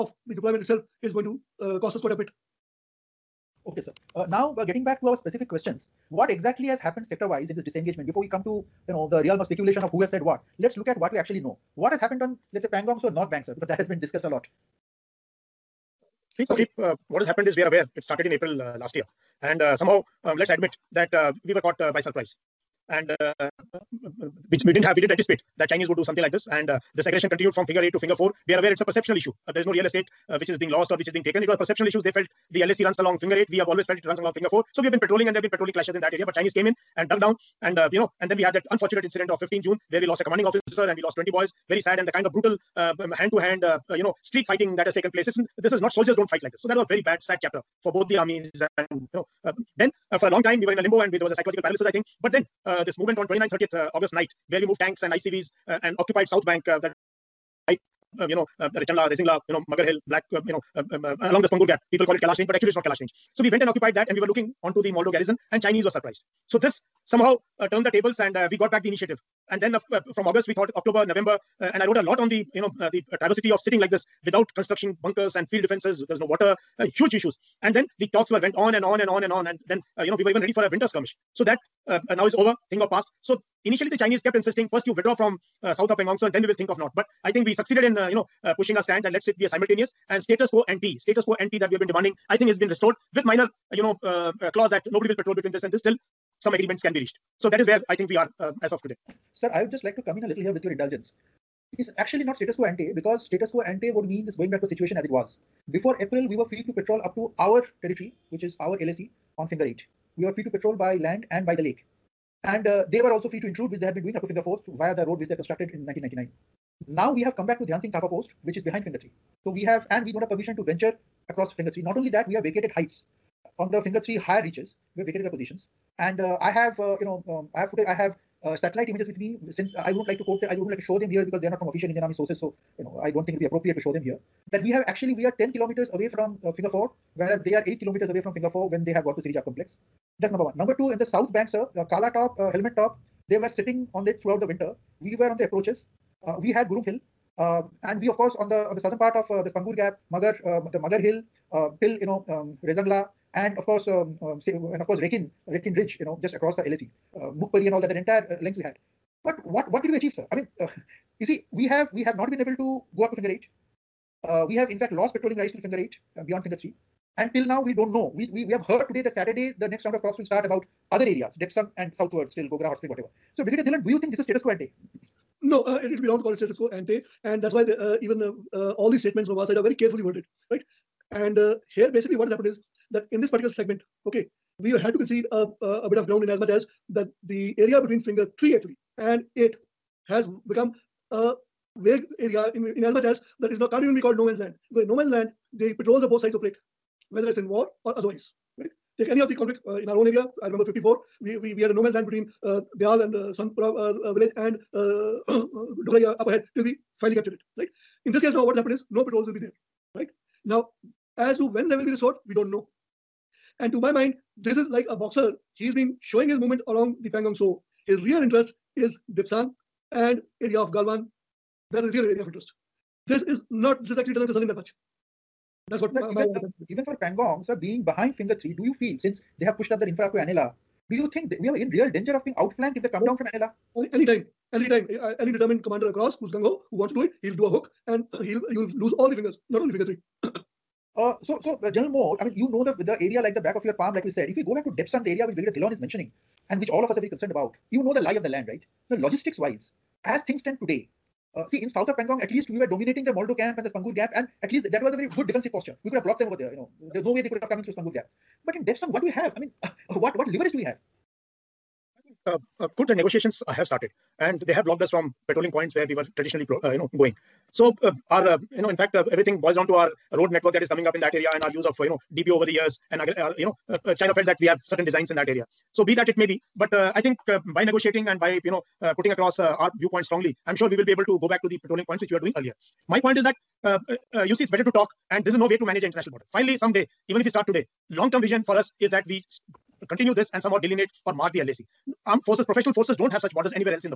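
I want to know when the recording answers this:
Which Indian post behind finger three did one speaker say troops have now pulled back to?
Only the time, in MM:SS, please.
01:57.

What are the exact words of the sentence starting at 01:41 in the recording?
It's actually not status quo ante because status quo ante would mean this going back to a situation as it was.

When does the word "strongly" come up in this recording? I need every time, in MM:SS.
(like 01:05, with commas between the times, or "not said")
04:40.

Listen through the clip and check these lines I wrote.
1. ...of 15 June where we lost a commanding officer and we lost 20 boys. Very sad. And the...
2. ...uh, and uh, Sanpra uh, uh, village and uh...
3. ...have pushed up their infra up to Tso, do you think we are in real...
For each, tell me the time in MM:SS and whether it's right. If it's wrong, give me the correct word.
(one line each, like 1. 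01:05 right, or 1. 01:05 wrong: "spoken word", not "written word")
1. 00:39 right
2. 03:22 right
3. 03:49 wrong: "Anela", not "Tso".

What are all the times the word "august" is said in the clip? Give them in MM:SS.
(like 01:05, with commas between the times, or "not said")
00:53, 01:10.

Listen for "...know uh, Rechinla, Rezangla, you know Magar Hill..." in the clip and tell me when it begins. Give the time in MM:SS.
00:58.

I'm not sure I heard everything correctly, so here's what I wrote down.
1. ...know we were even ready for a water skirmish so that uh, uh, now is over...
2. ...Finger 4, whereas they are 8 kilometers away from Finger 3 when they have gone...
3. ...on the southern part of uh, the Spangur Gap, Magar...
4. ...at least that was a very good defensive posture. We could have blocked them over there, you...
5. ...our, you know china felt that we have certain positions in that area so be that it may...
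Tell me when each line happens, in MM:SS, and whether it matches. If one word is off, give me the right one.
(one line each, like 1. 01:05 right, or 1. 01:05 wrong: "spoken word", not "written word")
1. 01:20 wrong: "winter", not "water"
2. 02:16 wrong: "4", not "3"
3. 02:28 right
4. 04:14 right
5. 04:32 wrong: "designs", not "positions".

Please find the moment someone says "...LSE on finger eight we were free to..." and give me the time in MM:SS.
01:48.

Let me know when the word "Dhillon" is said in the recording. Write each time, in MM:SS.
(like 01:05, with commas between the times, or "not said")
02:53, 04:05.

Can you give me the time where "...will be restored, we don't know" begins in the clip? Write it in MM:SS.
03:31.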